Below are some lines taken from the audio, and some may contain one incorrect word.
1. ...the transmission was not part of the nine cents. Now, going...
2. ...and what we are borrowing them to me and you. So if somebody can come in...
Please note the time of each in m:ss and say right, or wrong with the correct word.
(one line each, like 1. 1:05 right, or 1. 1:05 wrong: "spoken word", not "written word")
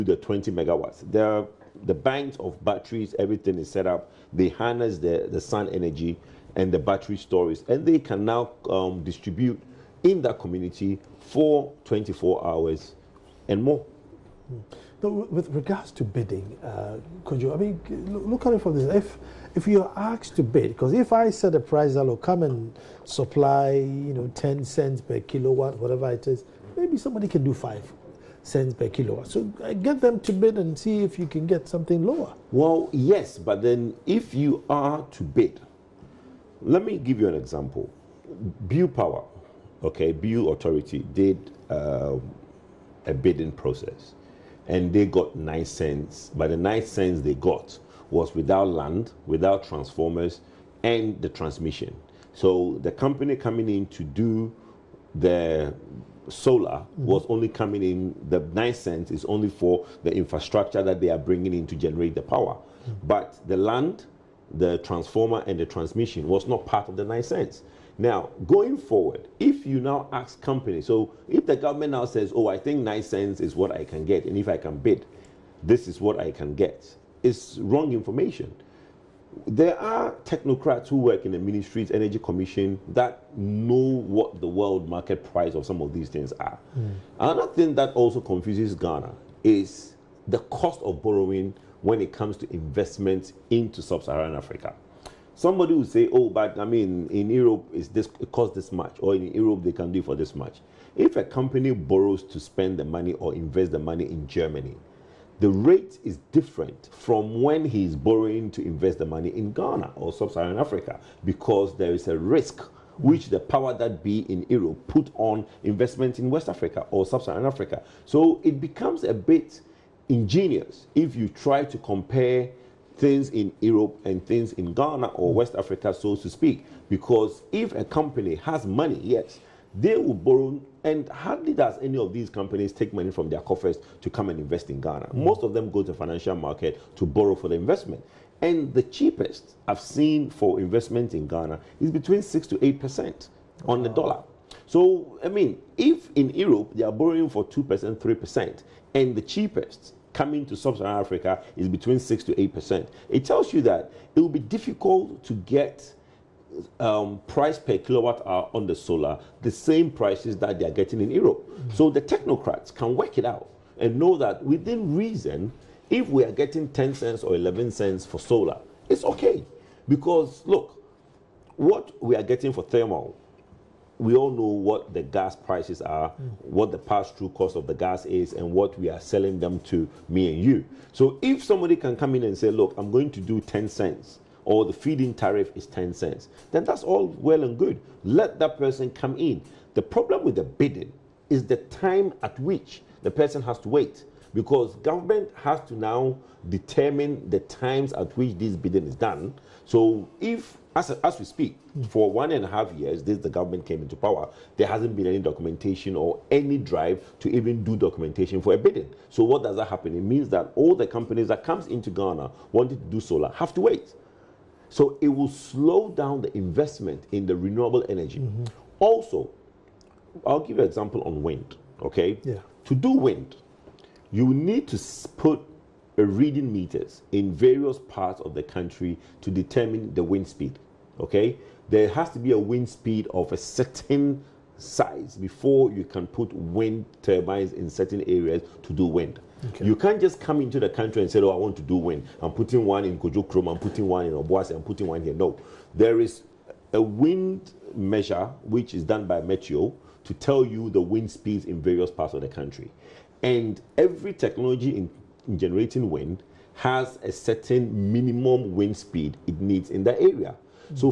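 1. 1:05 right
2. 2:58 wrong: "selling", not "borrowing".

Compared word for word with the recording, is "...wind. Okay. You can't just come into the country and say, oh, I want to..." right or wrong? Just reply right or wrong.
right.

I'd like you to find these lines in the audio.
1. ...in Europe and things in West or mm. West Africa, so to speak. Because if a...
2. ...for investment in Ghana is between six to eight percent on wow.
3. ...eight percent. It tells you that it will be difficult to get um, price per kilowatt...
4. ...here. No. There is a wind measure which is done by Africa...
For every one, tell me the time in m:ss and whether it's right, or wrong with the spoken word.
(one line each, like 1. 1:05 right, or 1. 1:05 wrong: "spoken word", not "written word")
1. 2:03 wrong: "Ghana", not "West"
2. 2:20 right
3. 2:32 right
4. 4:05 wrong: "Meteo", not "Africa".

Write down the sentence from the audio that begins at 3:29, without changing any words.
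It means that all the companies that comes into Ghana wanting to do solar have to wait.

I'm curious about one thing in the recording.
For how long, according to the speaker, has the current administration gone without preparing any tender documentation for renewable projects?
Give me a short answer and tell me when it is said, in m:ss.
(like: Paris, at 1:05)
1.5 years, at 3:22.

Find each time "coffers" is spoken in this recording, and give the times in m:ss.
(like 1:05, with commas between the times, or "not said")
2:13.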